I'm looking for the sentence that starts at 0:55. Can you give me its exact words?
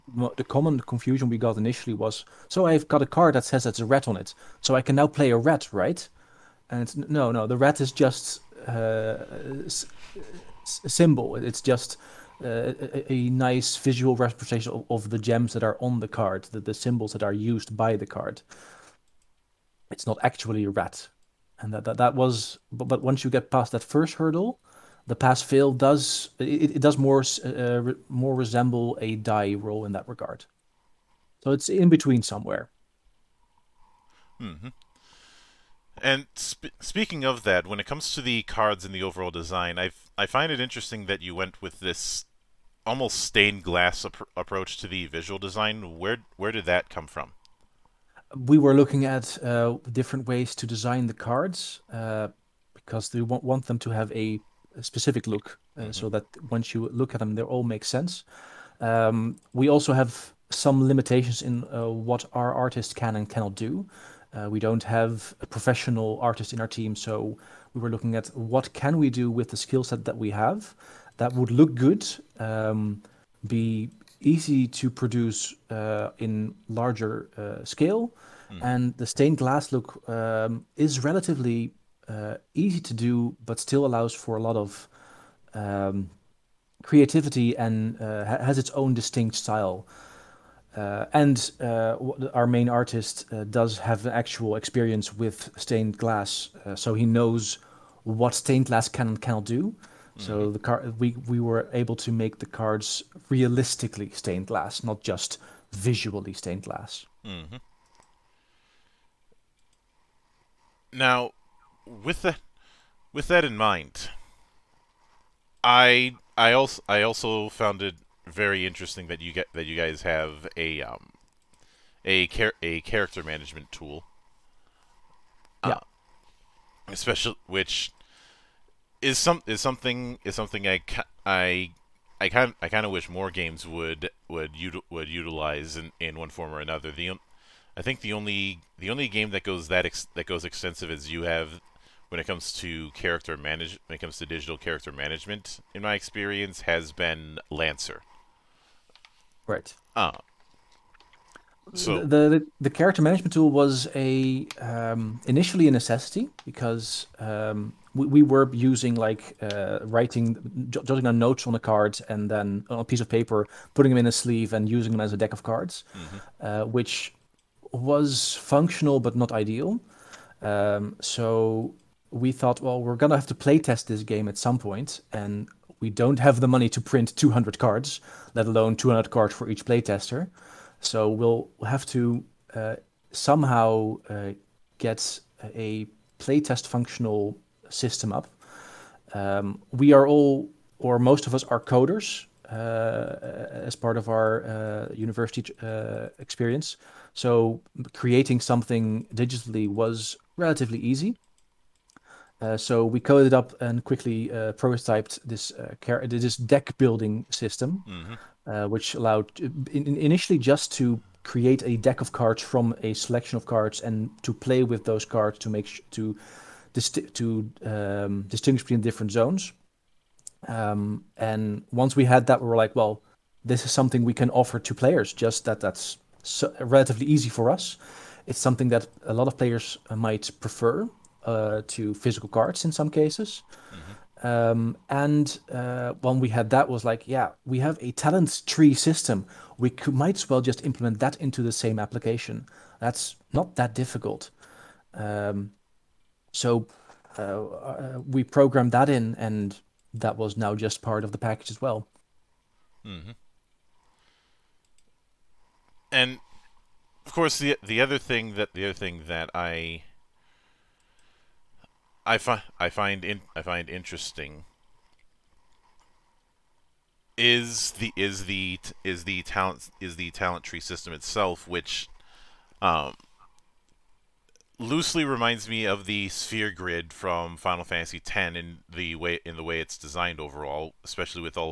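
so that once you look at them, they all make sense.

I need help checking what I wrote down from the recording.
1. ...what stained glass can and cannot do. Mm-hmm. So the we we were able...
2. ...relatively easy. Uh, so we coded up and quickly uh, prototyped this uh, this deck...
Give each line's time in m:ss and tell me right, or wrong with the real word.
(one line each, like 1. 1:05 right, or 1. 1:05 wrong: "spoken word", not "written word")
1. 1:38 right
2. 3:20 right.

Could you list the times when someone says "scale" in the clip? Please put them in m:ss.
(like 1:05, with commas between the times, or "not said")
1:17.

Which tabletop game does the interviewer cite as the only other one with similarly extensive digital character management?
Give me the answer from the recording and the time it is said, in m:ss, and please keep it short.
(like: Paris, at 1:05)
Lancer, at 2:27.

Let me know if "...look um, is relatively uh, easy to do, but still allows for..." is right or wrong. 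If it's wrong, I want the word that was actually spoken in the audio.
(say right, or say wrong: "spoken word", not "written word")
right.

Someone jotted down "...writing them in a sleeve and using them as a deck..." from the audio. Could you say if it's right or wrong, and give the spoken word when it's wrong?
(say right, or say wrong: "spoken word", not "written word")
wrong: "putting", not "writing".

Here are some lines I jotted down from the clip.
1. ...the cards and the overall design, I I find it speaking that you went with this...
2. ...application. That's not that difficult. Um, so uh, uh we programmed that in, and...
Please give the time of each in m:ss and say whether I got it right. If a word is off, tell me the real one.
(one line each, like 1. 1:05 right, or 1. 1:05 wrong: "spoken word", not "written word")
1. 0:38 wrong: "interesting", not "speaking"
2. 4:01 right.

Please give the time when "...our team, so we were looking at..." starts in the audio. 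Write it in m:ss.
1:06.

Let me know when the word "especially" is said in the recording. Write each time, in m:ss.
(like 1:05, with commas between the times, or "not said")
2:06, 4:40.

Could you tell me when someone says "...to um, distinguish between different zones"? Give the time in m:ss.
3:37.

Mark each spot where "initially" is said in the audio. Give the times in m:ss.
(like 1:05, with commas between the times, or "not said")
0:01, 2:35, 3:29.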